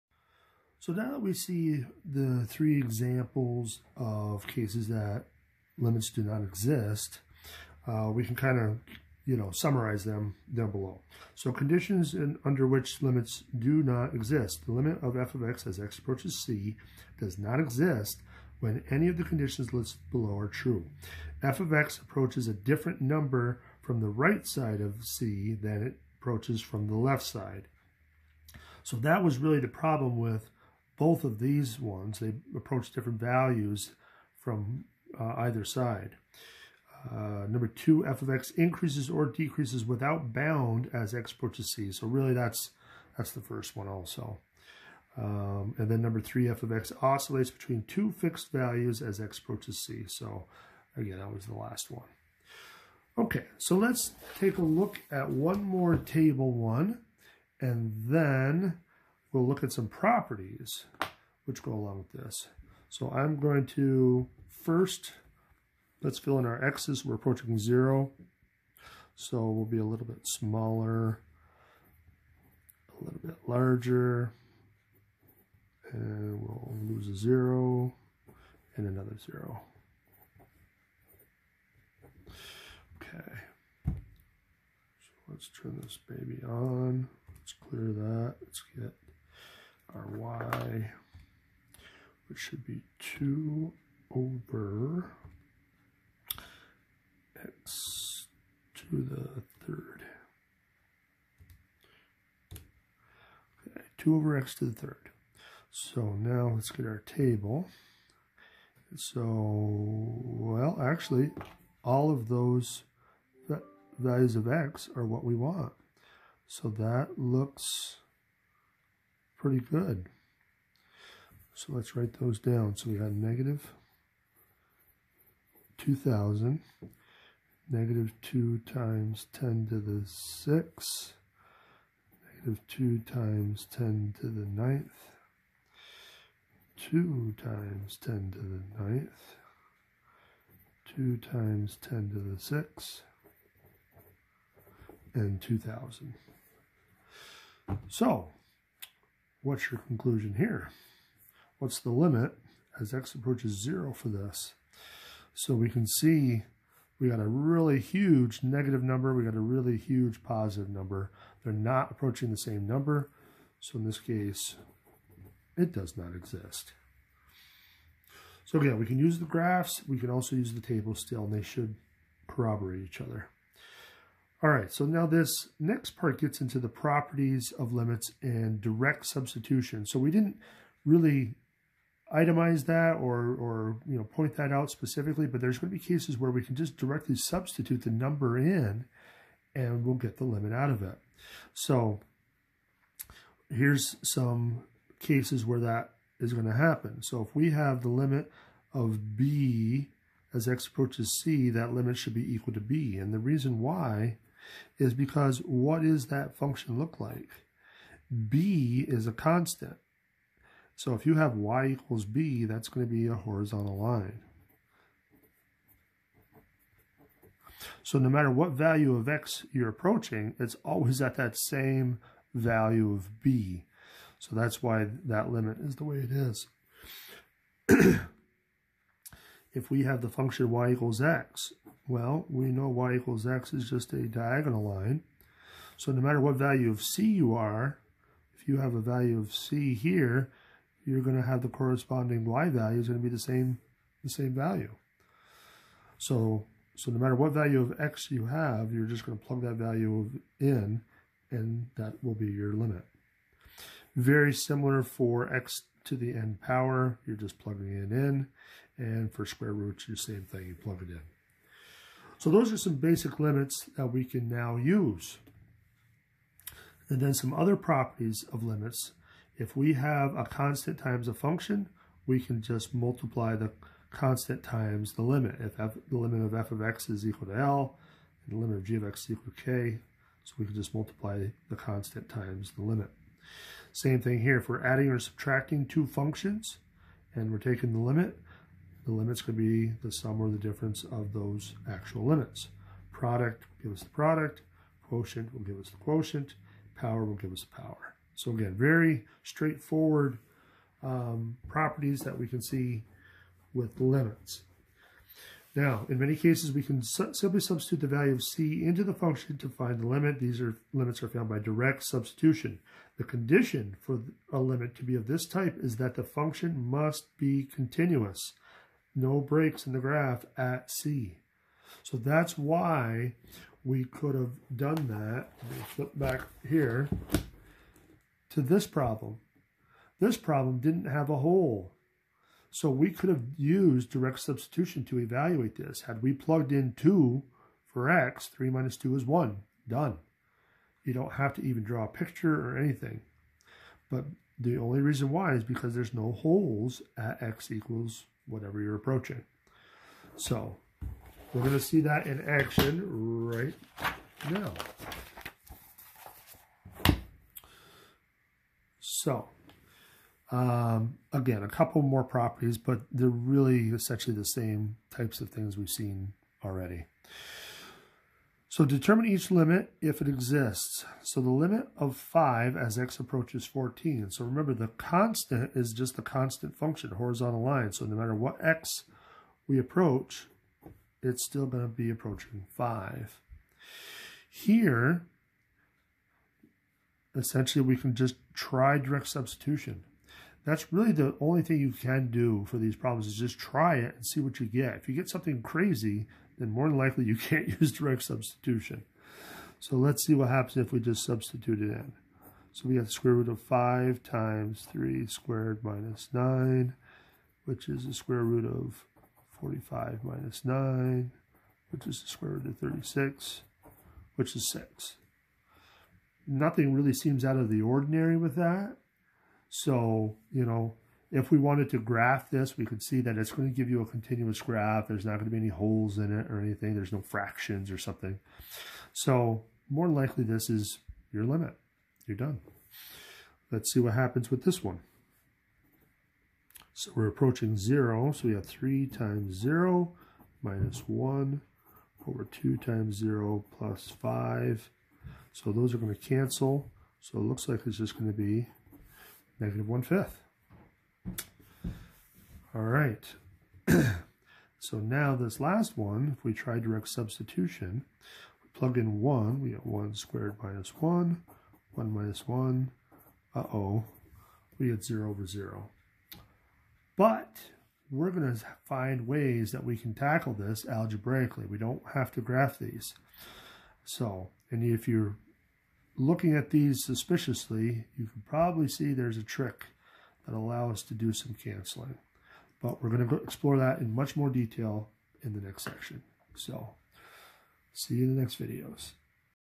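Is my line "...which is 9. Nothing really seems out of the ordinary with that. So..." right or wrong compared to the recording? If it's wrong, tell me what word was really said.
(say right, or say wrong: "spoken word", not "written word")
wrong: "6", not "9".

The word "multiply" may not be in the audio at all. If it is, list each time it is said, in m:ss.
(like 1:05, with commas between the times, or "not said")
4:32, 4:40.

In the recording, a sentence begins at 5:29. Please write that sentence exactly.
This problem didn't have a hole.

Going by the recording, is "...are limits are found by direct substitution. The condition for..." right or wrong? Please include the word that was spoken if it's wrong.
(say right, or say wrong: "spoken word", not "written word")
right.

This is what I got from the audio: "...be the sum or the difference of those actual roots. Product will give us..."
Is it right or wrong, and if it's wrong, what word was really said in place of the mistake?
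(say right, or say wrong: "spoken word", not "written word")
wrong: "limits", not "roots".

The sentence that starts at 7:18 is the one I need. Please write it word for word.
So we have 3 times 0 minus 1 over 2 times 0 plus 5.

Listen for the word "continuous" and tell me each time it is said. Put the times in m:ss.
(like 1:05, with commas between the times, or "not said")
5:17, 7:03.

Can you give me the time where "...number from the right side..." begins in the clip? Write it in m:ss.
0:23.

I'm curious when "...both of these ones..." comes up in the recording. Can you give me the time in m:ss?
0:31.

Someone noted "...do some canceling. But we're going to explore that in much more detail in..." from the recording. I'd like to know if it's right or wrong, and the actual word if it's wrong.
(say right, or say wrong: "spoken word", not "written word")
right.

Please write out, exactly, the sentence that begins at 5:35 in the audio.
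Had we plugged in 2 for x, 3 minus 2 is 1.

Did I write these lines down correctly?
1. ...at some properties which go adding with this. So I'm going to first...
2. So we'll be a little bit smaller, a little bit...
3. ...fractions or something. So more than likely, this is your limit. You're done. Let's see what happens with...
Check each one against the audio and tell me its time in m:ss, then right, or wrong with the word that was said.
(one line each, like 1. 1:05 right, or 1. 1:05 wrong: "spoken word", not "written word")
1. 0:59 wrong: "along", not "adding"
2. 1:09 right
3. 7:07 right.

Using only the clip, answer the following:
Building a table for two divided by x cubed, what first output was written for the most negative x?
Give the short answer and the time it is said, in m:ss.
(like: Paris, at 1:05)
-2000, at 2:03.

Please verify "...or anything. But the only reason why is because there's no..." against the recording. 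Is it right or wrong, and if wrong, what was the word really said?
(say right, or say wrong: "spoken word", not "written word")
right.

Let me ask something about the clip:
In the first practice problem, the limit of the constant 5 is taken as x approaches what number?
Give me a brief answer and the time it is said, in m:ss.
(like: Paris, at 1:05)
14, at 6:13.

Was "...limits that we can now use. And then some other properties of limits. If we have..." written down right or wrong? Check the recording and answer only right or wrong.
right.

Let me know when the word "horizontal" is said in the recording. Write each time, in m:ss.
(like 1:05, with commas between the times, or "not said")
3:33, 6:16.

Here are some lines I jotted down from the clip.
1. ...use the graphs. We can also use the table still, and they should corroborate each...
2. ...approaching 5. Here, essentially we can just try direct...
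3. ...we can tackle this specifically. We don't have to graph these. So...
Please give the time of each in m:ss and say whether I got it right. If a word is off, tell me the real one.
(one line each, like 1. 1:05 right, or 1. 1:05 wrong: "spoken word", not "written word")
1. 2:48 right
2. 6:21 right
3. 7:49 wrong: "algebraically", not "specifically".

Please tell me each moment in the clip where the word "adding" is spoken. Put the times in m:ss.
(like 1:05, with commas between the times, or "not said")
4:44.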